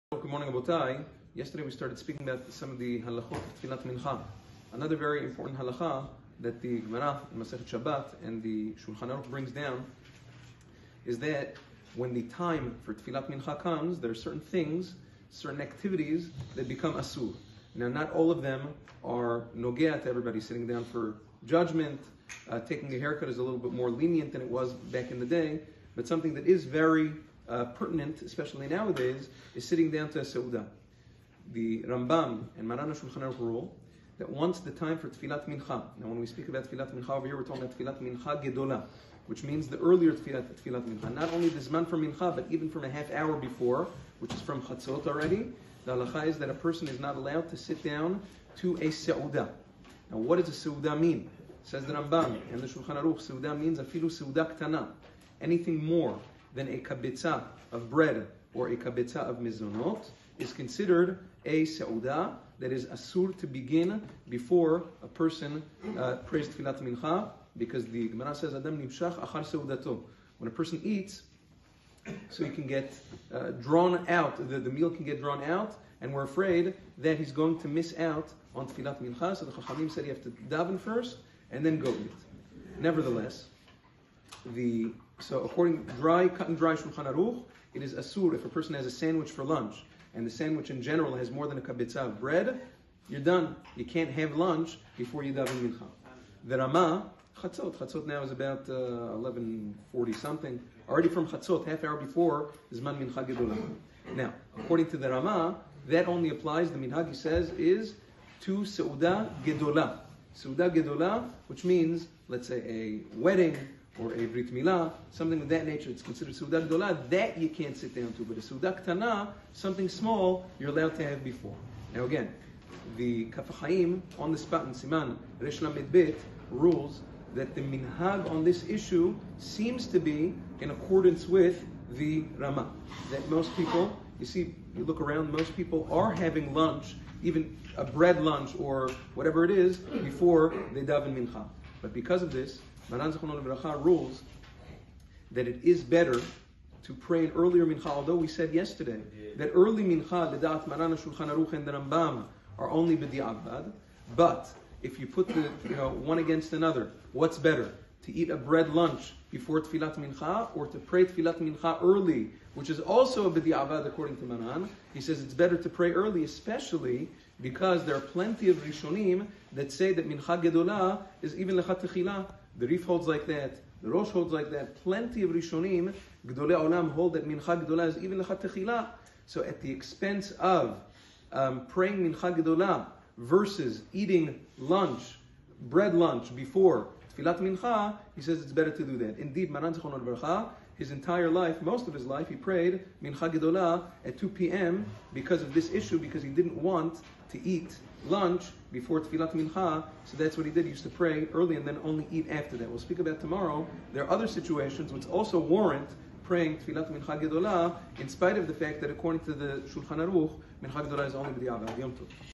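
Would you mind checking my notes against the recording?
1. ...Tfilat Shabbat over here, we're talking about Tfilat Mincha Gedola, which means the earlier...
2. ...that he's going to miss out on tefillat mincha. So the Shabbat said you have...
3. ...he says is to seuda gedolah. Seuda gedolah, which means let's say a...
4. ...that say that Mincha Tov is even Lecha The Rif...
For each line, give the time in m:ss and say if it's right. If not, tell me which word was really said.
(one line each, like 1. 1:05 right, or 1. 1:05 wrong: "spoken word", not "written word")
1. 0:36 wrong: "Mincha", not "Shabbat"
2. 1:16 wrong: "Chachamim", not "Shabbat"
3. 1:47 right
4. 2:49 wrong: "Gedolah", not "Tov".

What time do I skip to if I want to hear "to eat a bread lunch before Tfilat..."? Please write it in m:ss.
2:38.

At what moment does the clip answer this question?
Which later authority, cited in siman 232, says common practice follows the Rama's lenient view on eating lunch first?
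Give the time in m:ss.
2:03.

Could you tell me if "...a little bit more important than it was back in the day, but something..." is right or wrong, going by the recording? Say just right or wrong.
wrong.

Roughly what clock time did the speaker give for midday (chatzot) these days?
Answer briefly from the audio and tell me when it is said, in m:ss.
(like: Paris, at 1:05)
11:40, at 1:39.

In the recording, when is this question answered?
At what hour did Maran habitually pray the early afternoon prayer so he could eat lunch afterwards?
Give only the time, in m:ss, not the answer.
3:14.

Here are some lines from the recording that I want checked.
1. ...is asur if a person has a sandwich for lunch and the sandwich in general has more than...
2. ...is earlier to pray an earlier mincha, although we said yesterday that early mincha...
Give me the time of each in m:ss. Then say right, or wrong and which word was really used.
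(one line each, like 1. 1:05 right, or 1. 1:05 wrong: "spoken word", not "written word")
1. 1:27 right
2. 2:25 wrong: "better", not "earlier".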